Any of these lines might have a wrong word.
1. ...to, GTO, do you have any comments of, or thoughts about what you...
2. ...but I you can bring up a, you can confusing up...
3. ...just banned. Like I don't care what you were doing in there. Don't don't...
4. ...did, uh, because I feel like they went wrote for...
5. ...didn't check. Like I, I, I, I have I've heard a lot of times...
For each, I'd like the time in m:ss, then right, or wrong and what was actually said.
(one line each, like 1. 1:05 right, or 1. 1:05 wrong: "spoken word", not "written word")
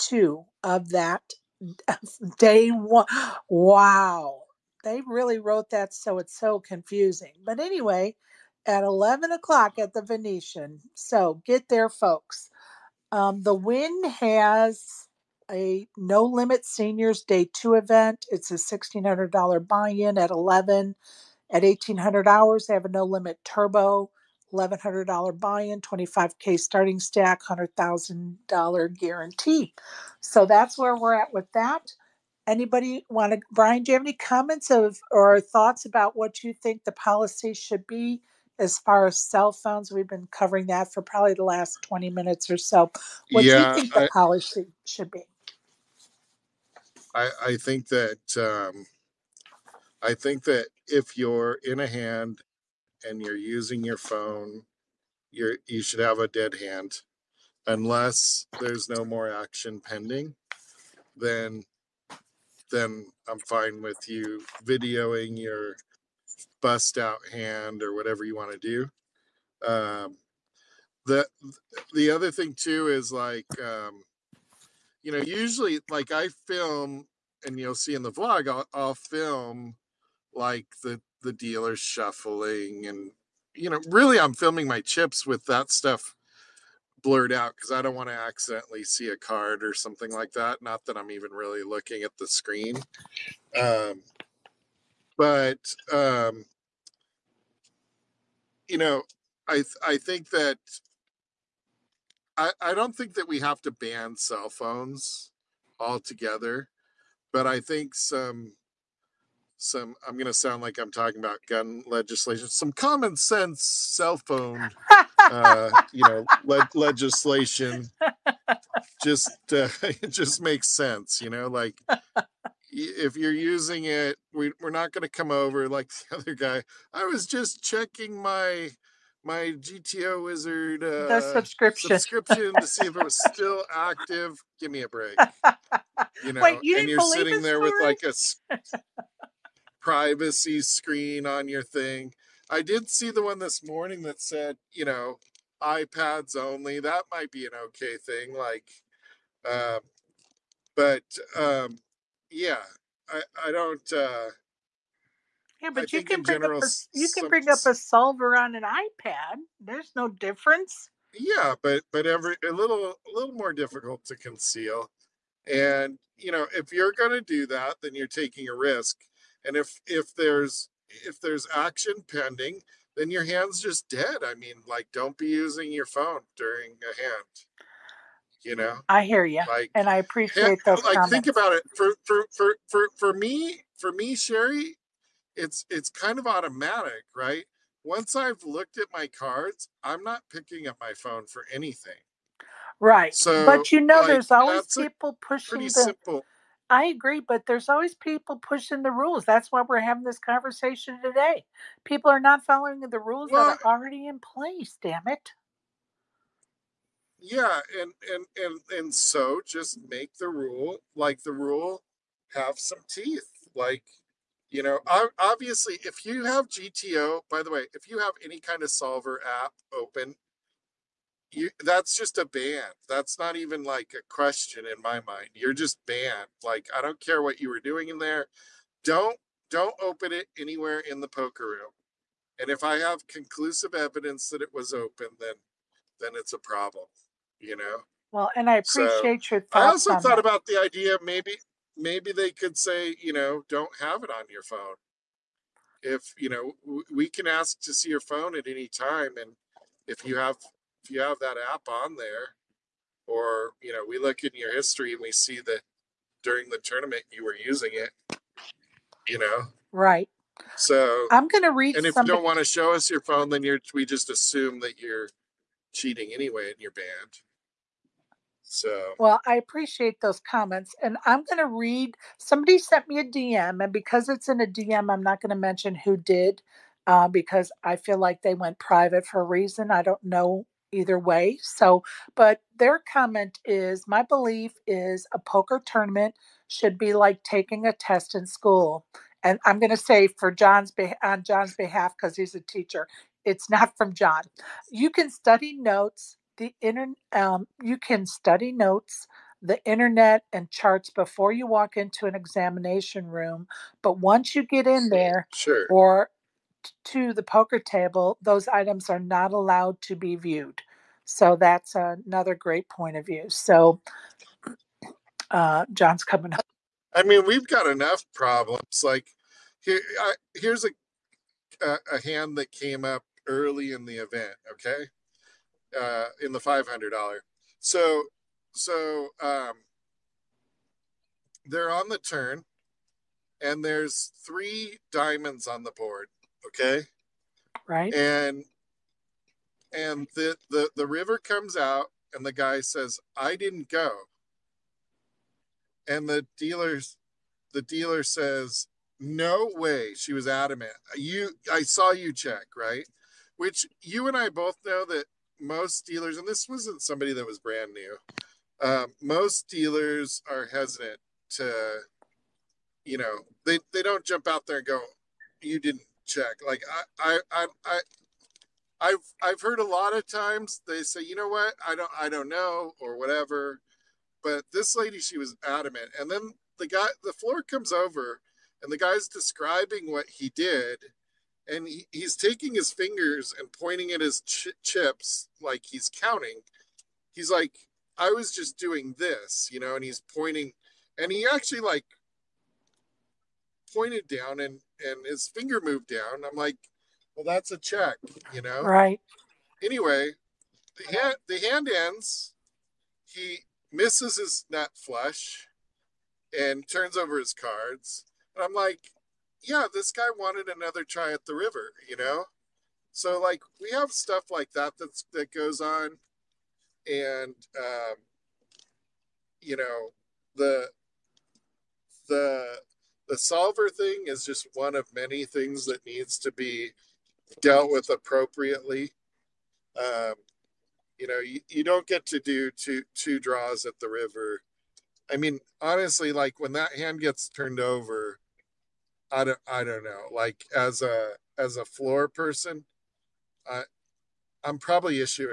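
1. 0:33 wrong: "Brian", not "GTO"
2. 2:35 wrong: "bring", not "confusing"
3. 3:45 right
4. 4:35 wrong: "private", not "wrote"
5. 6:05 right.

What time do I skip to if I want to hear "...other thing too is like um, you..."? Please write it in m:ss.
1:12.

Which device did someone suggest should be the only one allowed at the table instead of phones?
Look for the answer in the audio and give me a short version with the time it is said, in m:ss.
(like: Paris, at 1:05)
iPads, at 2:25.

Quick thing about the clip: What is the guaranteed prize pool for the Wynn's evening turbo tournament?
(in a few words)
$100,000.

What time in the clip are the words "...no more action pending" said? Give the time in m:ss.
0:58.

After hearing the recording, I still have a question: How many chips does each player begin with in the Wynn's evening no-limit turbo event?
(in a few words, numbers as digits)
25K.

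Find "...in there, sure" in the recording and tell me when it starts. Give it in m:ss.
5:04.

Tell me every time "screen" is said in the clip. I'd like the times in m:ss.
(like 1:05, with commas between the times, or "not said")
1:32, 2:20.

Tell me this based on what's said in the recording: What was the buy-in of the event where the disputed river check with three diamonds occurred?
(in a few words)
$500.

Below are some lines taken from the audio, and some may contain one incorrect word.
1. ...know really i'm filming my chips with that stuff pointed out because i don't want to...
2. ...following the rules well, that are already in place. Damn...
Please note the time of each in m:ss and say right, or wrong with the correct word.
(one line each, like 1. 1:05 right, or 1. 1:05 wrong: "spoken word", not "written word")
1. 1:23 wrong: "blurred", not "pointed"
2. 3:22 right.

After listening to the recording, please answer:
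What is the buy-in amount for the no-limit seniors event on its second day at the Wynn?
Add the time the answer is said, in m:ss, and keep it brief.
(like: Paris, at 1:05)
$1,600, at 0:18.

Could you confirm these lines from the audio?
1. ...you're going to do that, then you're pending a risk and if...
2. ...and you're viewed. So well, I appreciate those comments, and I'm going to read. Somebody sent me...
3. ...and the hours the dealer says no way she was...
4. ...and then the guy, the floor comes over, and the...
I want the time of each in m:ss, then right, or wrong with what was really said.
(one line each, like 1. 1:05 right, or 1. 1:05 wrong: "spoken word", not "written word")
1. 2:46 wrong: "taking", not "pending"
2. 4:26 wrong: "banned", not "viewed"
3. 5:45 wrong: "dealers", not "hours"
4. 6:15 right.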